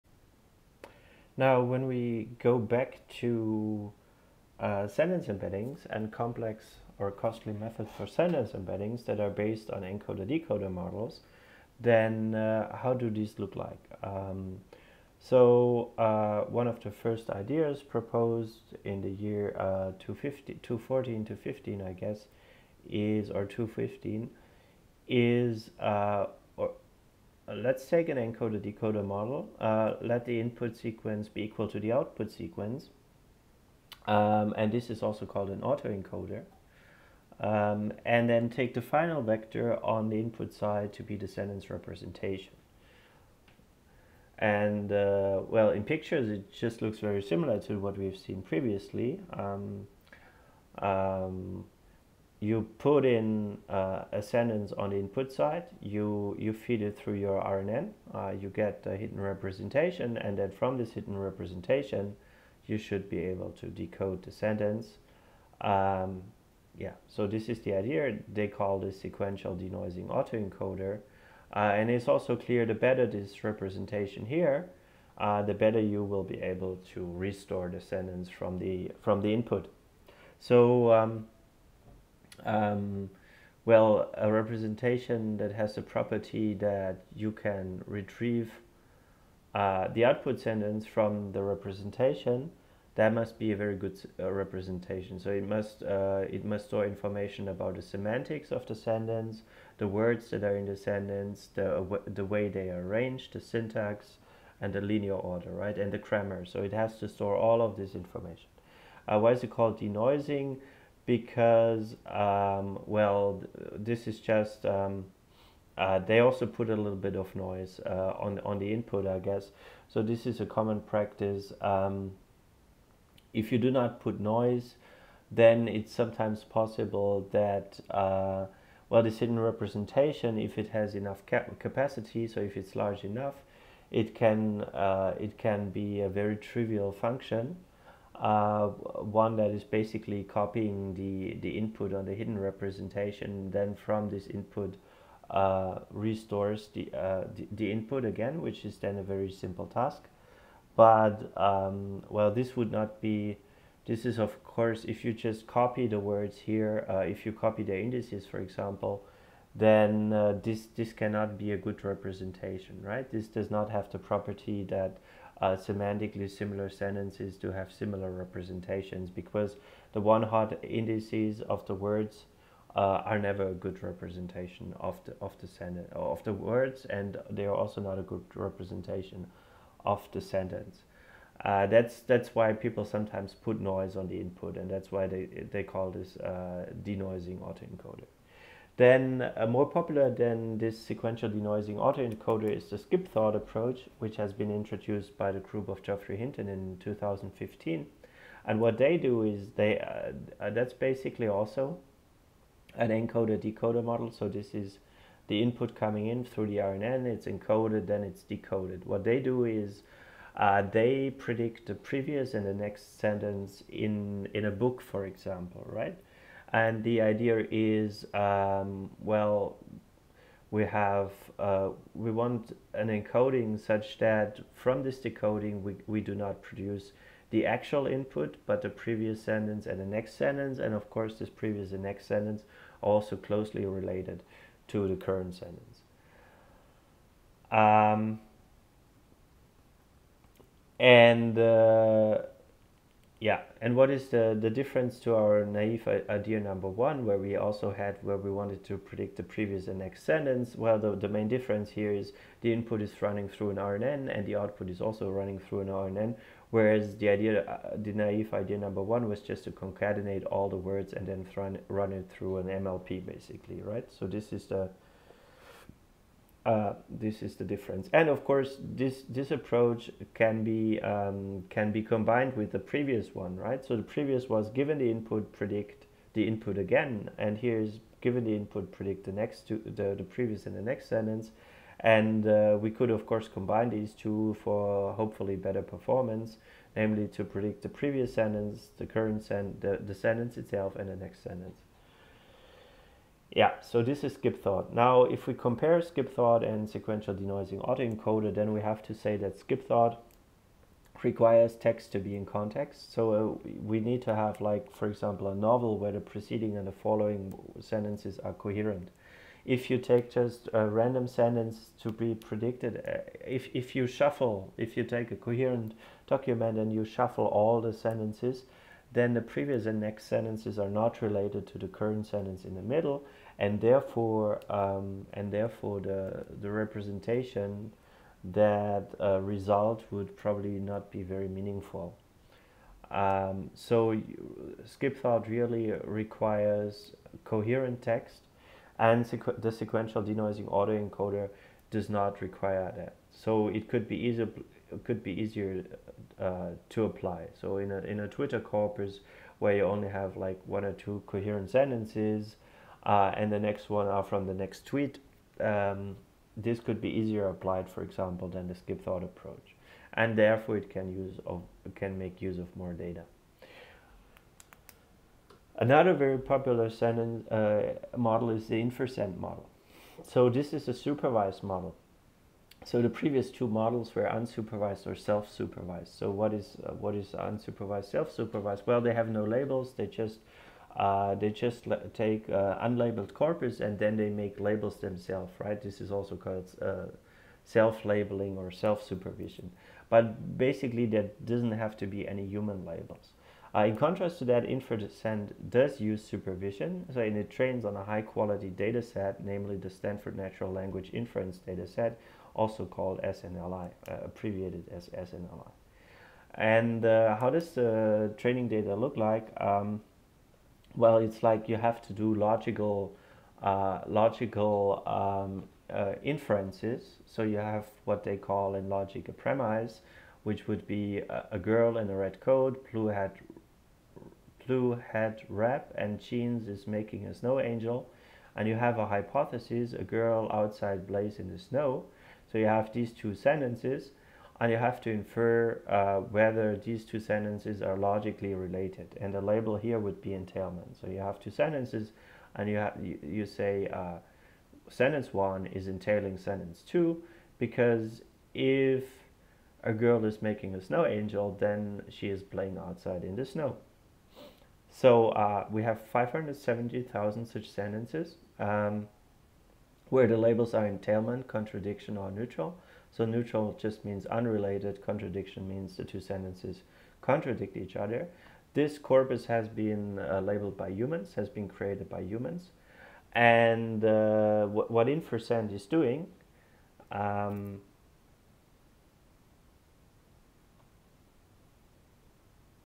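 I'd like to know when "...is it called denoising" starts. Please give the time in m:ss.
1:49.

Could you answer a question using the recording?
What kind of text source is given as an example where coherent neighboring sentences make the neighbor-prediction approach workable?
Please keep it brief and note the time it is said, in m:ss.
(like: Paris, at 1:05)
a novel, at 5:05.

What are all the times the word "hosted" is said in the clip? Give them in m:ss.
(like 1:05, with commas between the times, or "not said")
not said.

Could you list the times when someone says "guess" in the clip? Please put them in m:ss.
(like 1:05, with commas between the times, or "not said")
0:21, 1:59.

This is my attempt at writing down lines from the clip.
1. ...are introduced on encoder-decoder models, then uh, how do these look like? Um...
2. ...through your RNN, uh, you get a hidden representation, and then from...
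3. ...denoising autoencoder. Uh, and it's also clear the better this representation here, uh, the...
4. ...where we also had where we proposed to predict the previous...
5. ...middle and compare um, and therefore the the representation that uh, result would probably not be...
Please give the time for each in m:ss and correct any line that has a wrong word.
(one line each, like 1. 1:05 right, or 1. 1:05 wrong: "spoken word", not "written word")
1. 0:09 wrong: "based", not "introduced"
2. 0:56 right
3. 1:09 right
4. 4:07 wrong: "wanted", not "proposed"
5. 5:22 wrong: "therefore", not "compare".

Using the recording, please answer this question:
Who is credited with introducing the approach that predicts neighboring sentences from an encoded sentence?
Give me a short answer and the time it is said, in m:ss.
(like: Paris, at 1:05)
Geoffrey Hinton, at 3:15.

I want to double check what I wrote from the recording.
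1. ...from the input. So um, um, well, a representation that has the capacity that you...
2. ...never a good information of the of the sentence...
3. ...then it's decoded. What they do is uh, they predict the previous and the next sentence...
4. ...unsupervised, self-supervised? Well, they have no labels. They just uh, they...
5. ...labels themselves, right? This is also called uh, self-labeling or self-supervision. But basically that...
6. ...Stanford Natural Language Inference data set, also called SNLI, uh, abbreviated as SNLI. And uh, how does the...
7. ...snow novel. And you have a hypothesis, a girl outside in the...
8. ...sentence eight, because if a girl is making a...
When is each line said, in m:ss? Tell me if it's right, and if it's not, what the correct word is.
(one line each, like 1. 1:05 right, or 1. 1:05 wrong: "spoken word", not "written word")
1. 1:19 wrong: "property", not "capacity"
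2. 2:53 wrong: "representation", not "information"
3. 3:27 right
4. 6:17 right
5. 6:24 right
6. 6:39 right
7. 7:07 wrong: "angel", not "novel"
8. 7:26 wrong: "two", not "eight".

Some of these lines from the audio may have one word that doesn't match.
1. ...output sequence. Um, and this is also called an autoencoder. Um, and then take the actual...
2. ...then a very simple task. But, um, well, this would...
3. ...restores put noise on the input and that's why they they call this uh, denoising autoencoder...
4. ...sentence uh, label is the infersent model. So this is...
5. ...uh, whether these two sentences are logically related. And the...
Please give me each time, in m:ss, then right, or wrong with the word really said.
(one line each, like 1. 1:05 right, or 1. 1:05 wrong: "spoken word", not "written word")
1. 0:31 wrong: "final", not "actual"
2. 2:28 right
3. 3:02 wrong: "sometimes", not "restores"
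4. 6:06 wrong: "model", not "label"
5. 7:15 right.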